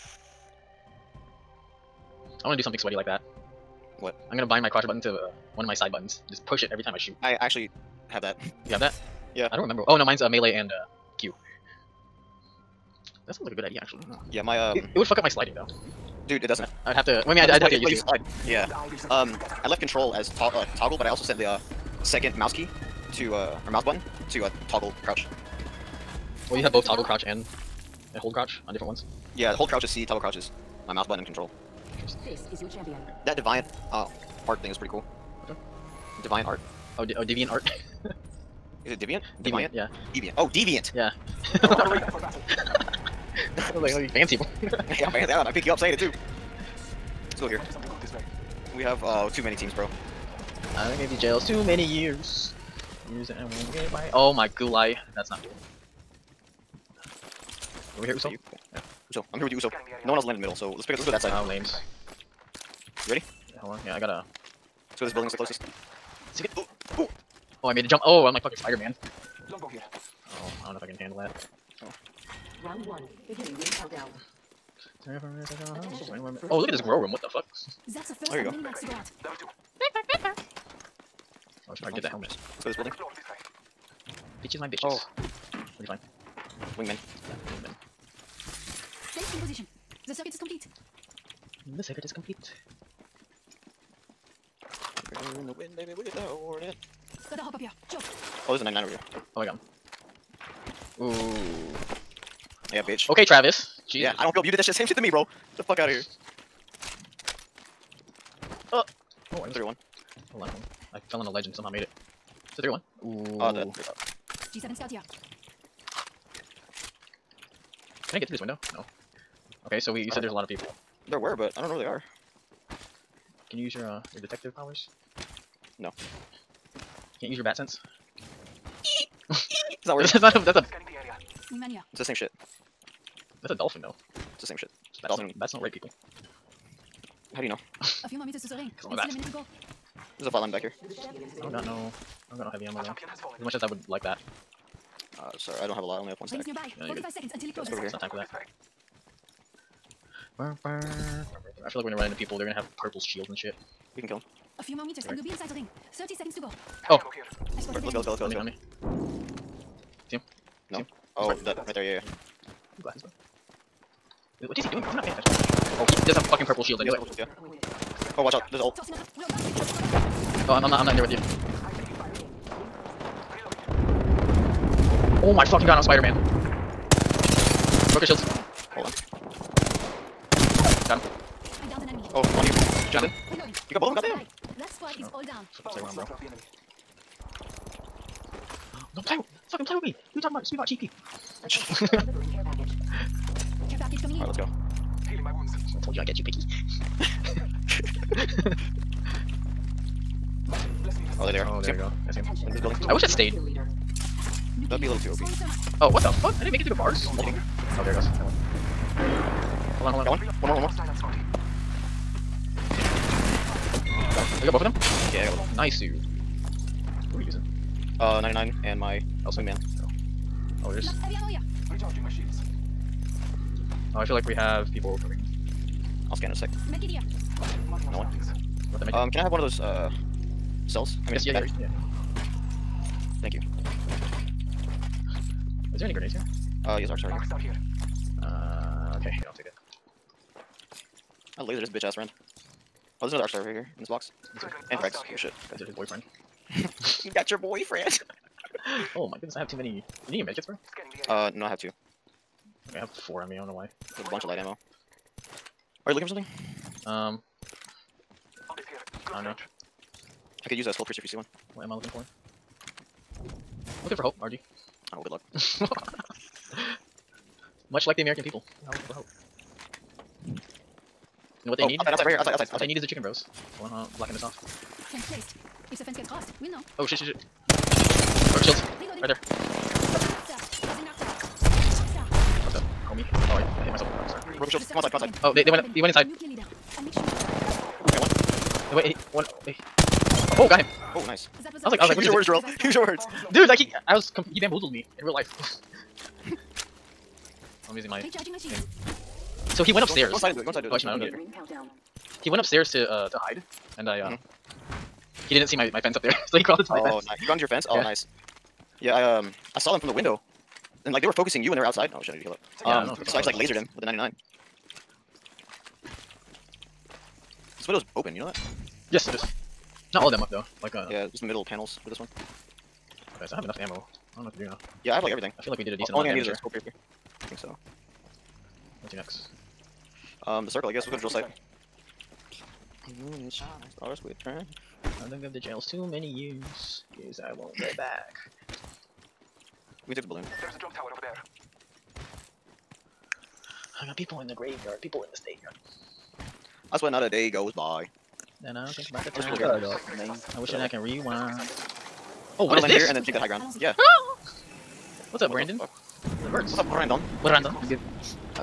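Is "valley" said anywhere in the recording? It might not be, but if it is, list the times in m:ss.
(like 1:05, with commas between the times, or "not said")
not said.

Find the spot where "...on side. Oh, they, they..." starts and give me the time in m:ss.
4:44.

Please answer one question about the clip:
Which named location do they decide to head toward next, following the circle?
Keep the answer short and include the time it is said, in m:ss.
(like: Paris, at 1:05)
Drill site, at 5:30.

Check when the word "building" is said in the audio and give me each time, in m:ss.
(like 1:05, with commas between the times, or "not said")
1:05, 1:22, 3:22.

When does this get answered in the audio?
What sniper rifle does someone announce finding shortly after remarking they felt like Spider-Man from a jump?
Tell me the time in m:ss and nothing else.
1:09.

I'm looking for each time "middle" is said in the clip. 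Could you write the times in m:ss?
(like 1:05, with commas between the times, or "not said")
1:00, 5:21.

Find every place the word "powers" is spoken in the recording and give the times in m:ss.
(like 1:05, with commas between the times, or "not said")
2:04.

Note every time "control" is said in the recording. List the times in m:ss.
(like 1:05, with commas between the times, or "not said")
0:19, 0:31.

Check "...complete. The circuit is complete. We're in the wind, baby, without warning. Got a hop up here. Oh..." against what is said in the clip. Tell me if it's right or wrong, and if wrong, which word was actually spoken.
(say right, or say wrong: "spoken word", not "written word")
right.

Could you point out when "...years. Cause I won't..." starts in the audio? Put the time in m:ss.
5:36.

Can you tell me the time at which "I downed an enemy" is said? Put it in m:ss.
3:01.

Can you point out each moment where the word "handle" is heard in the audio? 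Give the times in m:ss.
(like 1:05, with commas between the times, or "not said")
1:10.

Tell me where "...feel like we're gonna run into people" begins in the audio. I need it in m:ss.
2:31.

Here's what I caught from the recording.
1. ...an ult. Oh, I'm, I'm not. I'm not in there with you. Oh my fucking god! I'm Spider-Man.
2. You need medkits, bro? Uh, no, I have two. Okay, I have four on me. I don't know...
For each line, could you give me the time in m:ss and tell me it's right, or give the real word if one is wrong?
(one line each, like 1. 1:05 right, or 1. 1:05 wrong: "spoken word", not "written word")
1. 2:48 right
2. 4:10 right.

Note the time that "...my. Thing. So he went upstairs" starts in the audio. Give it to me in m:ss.
4:57.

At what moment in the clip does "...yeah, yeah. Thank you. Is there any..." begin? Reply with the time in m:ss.
3:51.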